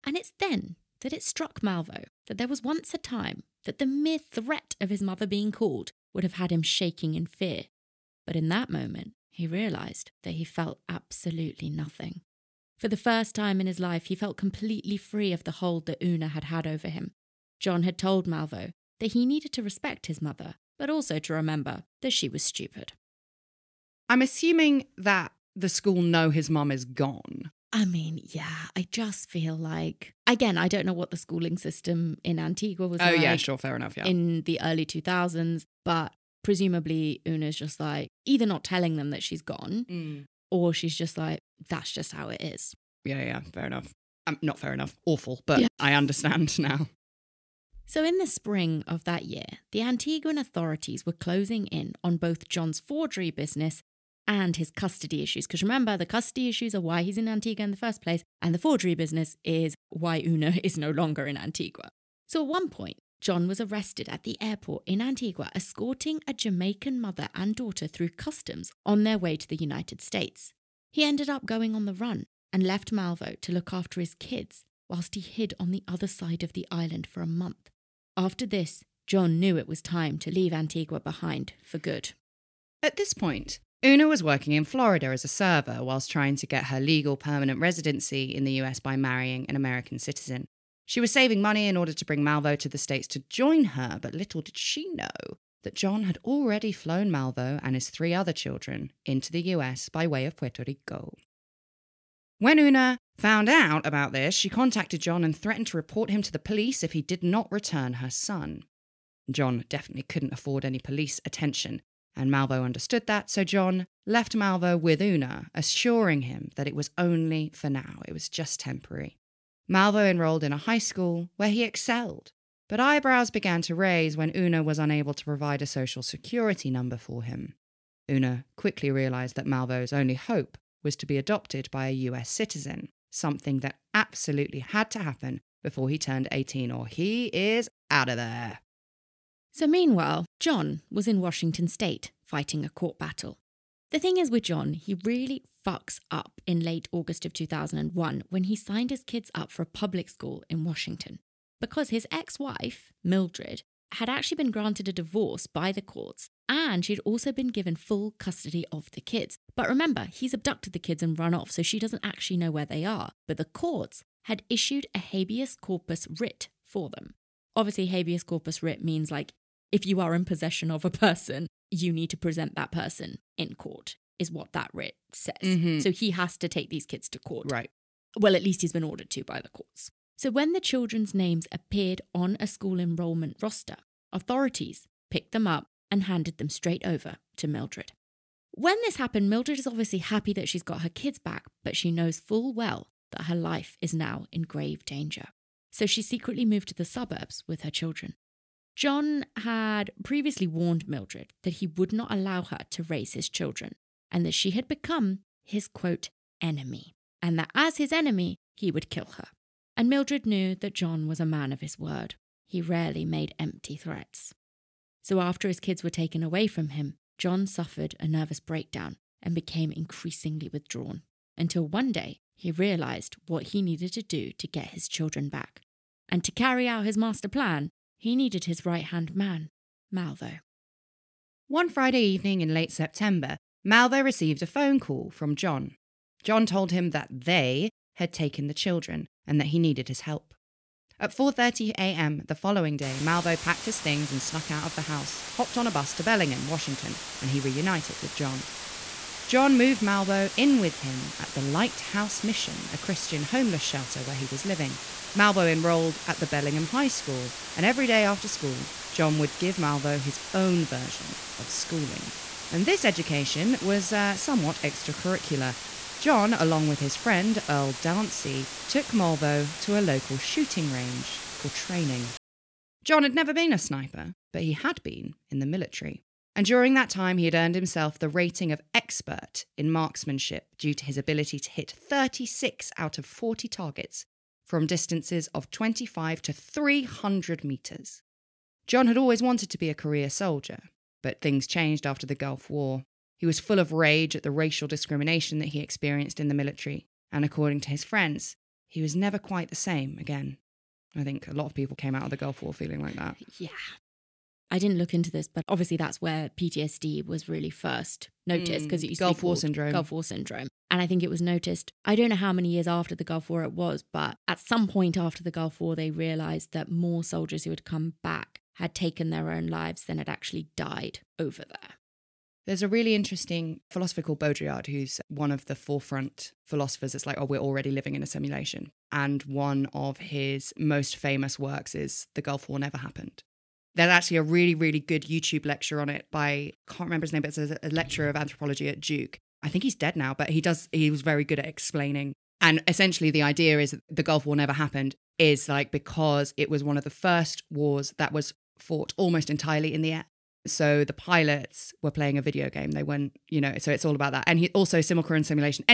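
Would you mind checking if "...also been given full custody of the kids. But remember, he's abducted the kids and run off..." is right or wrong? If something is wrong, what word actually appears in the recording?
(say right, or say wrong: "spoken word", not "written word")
right.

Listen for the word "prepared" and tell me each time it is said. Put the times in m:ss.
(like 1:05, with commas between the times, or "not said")
not said.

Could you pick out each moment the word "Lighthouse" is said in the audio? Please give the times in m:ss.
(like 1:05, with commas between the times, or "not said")
4:11.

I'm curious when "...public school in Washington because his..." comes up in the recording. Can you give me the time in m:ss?
2:29.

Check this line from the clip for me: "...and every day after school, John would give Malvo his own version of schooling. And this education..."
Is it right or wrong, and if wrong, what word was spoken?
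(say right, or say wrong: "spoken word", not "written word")
right.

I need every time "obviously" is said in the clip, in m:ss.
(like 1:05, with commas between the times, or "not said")
2:47, 3:09, 5:05.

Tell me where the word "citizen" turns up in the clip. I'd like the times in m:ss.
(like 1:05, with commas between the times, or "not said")
1:29, 2:12.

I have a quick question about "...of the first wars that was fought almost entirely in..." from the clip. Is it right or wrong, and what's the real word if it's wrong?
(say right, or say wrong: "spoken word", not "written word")
right.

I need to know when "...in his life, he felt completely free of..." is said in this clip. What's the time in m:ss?
0:13.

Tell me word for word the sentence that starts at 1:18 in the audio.
After this, John knew it was time to leave Antigua behind for good.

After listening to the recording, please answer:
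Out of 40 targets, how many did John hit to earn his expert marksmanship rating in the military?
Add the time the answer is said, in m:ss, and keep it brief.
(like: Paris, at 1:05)
36, at 4:41.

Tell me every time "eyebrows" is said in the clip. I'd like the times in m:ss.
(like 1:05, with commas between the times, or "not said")
2:02.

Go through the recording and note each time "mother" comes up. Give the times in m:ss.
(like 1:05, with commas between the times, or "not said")
0:05, 0:20, 1:07.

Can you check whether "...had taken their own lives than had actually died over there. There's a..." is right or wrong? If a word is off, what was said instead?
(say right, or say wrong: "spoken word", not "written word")
right.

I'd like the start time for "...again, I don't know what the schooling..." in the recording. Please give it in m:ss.
0:30.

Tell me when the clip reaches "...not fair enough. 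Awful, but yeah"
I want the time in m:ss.
0:44.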